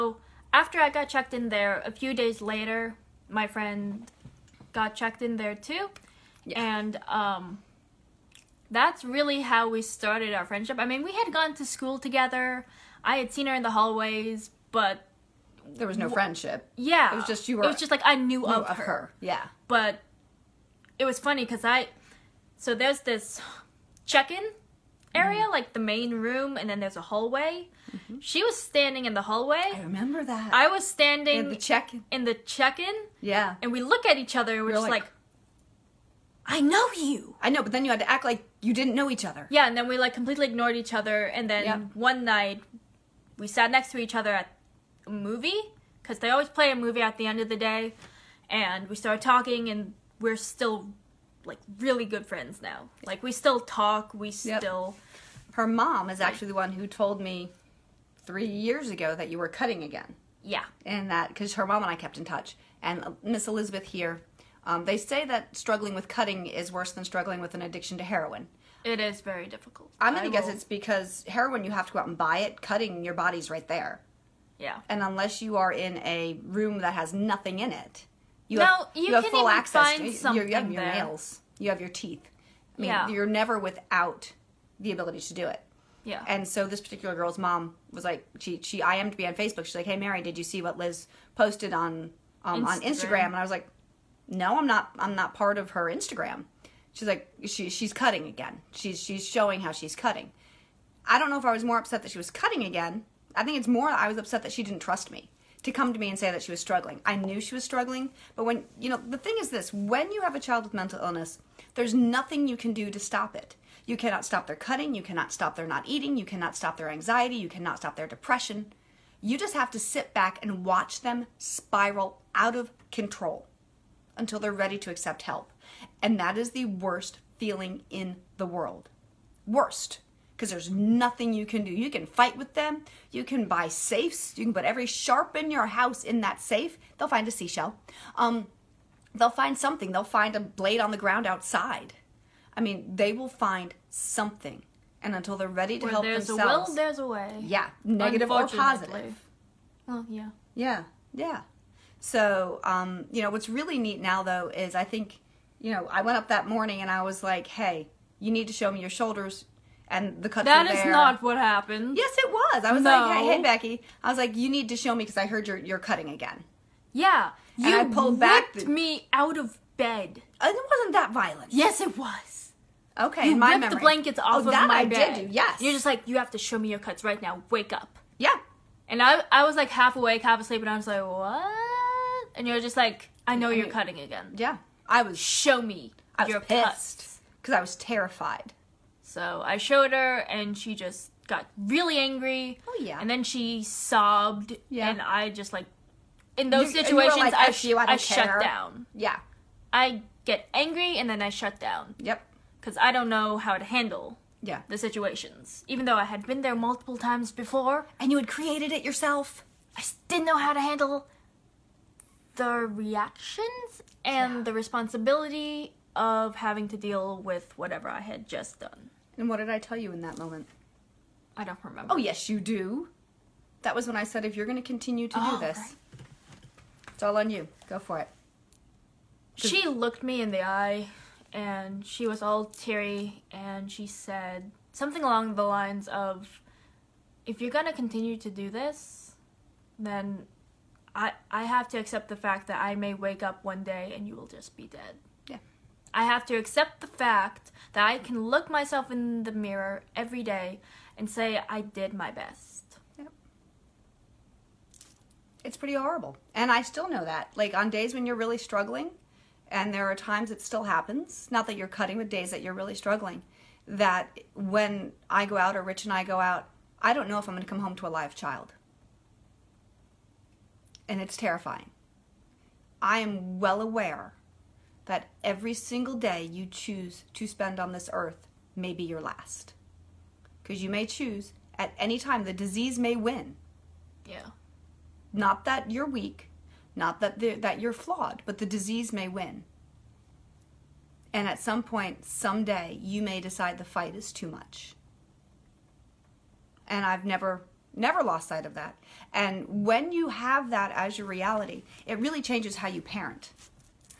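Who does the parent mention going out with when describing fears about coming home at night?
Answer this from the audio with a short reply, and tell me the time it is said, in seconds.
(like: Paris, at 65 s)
Rich, at 265 s.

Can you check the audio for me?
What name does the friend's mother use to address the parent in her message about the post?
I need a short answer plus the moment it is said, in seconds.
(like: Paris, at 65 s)
Mary, at 89 s.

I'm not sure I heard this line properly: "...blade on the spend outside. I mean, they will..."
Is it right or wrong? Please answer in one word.
wrong.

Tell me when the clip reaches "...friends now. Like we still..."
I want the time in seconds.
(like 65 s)
52 s.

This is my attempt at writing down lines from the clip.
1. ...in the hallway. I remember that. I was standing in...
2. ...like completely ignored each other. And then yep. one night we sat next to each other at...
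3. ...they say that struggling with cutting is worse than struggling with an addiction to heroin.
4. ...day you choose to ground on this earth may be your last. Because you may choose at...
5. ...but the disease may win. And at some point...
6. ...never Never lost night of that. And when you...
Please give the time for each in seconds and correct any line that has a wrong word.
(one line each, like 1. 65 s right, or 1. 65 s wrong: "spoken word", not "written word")
1. 29 s right
2. 39 s right
3. 64 s right
4. 275 s wrong: "spend", not "ground"
5. 288 s right
6. 297 s wrong: "sight", not "night".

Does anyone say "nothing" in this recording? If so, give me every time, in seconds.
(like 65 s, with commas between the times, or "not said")
77 s, 111 s, 130 s.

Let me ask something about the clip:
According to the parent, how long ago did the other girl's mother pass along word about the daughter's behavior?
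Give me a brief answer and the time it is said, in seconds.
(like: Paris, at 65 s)
3 years ago, at 58 s.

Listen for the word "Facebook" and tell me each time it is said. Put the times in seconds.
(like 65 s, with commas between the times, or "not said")
89 s.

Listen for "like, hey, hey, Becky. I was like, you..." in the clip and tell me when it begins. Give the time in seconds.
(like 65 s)
162 s.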